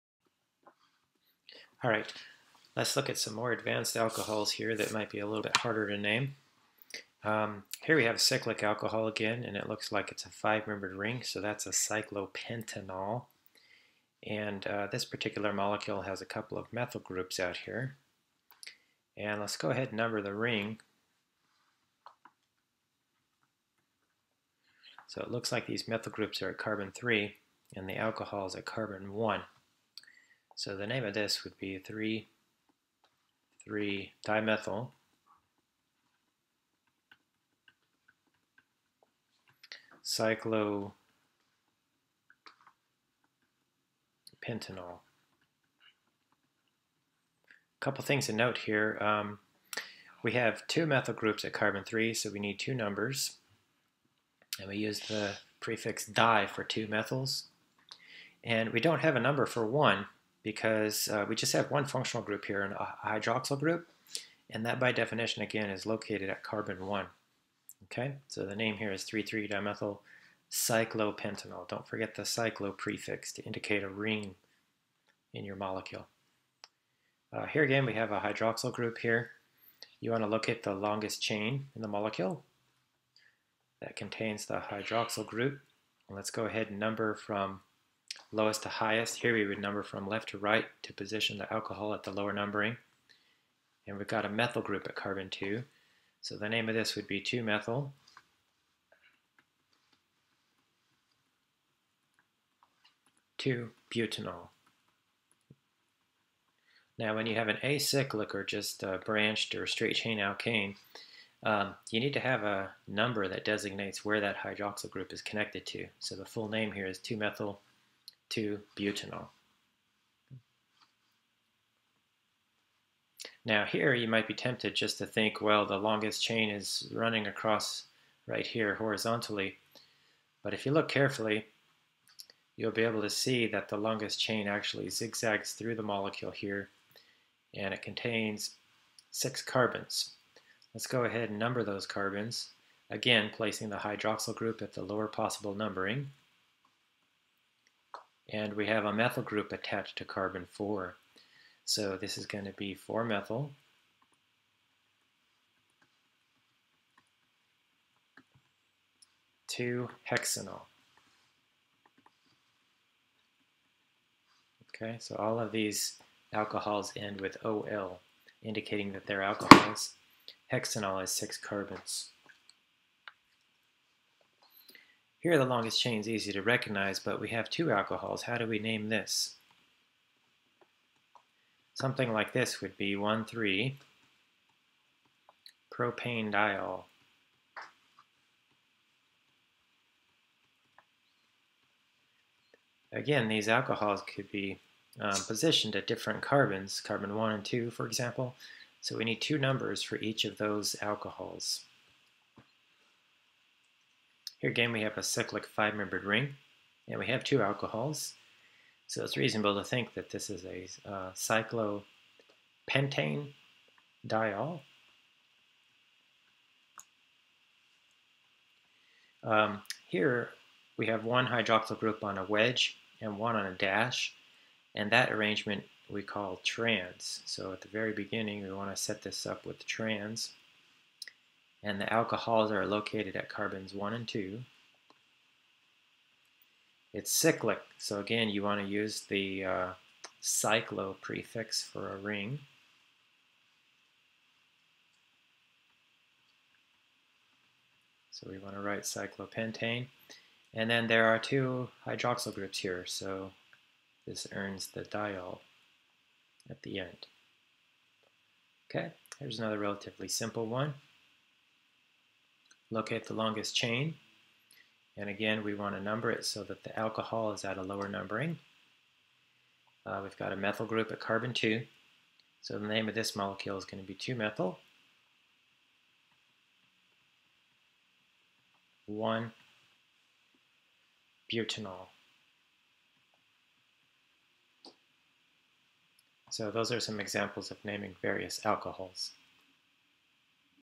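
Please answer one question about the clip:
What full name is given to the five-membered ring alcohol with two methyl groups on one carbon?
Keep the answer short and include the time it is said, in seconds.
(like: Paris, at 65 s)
3,3-dimethylcyclopentanol, at 33 s.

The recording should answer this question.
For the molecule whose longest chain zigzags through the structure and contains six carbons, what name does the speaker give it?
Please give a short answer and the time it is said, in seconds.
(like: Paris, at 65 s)
4-methyl-2-hexanol, at 159 s.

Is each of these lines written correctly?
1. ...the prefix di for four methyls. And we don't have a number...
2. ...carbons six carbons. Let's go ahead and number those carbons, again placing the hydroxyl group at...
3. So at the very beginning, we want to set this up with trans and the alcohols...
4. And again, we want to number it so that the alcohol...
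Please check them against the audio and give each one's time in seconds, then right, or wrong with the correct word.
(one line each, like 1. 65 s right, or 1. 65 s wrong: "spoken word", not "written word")
1. 54 s wrong: "two", not "four"
2. 137 s wrong: "contains", not "carbons"
3. 227 s right
4. 264 s right.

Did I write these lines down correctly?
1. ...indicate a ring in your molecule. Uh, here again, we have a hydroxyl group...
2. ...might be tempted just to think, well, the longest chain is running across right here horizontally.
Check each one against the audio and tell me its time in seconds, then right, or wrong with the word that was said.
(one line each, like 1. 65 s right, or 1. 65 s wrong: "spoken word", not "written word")
1. 73 s right
2. 124 s right.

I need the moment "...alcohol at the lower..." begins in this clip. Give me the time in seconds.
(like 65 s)
91 s.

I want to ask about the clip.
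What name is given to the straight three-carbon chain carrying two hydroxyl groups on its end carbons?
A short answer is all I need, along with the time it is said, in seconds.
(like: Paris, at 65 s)
1,3-propanediol, at 182 s.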